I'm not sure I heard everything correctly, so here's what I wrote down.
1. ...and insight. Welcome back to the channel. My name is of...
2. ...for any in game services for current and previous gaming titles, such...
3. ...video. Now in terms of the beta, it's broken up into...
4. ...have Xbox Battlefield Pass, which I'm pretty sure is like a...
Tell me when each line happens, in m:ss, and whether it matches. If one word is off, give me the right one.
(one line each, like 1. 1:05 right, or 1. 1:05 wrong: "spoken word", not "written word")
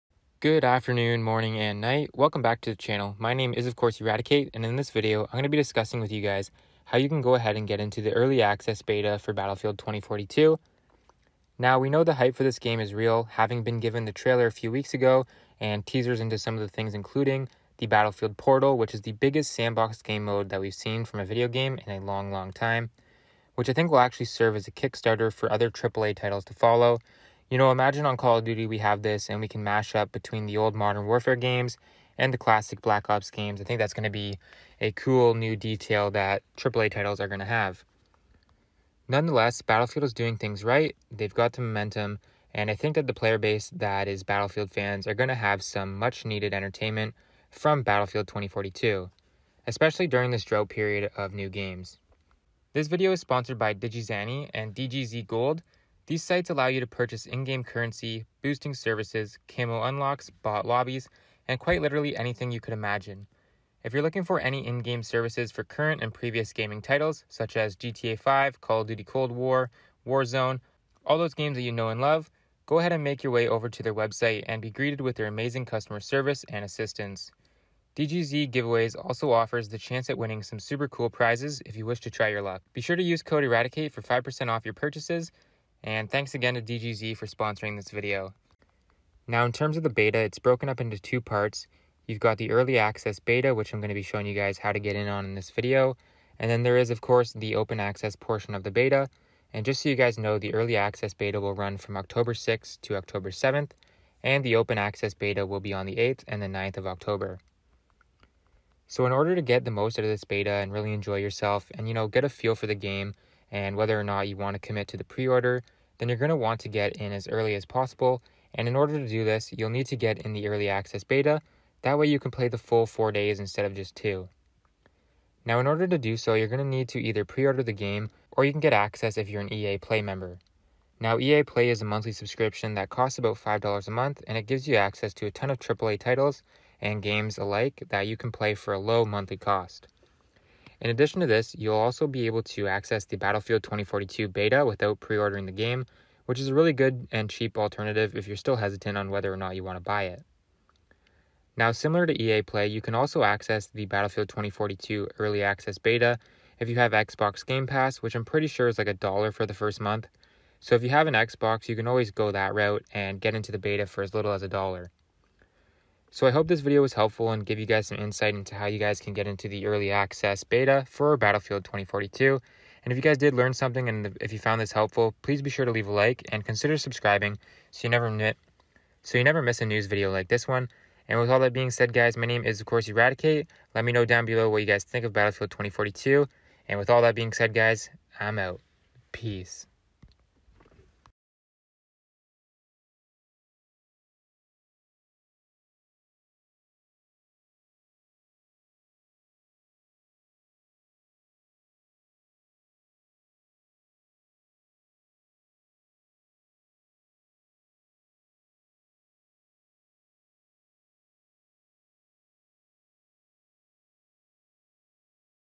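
1. 0:01 wrong: "night", not "insight"
2. 1:04 right
3. 1:27 right
4. 2:36 wrong: "Game", not "Battlefield".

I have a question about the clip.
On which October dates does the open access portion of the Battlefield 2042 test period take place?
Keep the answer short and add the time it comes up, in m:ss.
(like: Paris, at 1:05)
8th and 9th, at 1:45.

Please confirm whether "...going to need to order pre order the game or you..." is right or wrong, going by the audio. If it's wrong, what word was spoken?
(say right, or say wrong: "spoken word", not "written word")
wrong: "either", not "order".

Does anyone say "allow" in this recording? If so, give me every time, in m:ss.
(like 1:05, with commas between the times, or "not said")
0:56.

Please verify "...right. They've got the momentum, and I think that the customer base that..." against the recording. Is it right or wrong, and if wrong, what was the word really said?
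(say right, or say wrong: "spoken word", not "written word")
wrong: "player", not "customer".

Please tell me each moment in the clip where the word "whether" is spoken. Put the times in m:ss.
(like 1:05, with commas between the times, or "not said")
1:53, 2:29.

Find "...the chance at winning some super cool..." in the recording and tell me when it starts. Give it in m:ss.
1:19.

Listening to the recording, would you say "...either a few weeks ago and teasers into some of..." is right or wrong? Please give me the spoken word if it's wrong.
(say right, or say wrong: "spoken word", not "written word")
wrong: "trailer", not "either".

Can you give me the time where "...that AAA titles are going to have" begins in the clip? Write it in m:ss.
0:36.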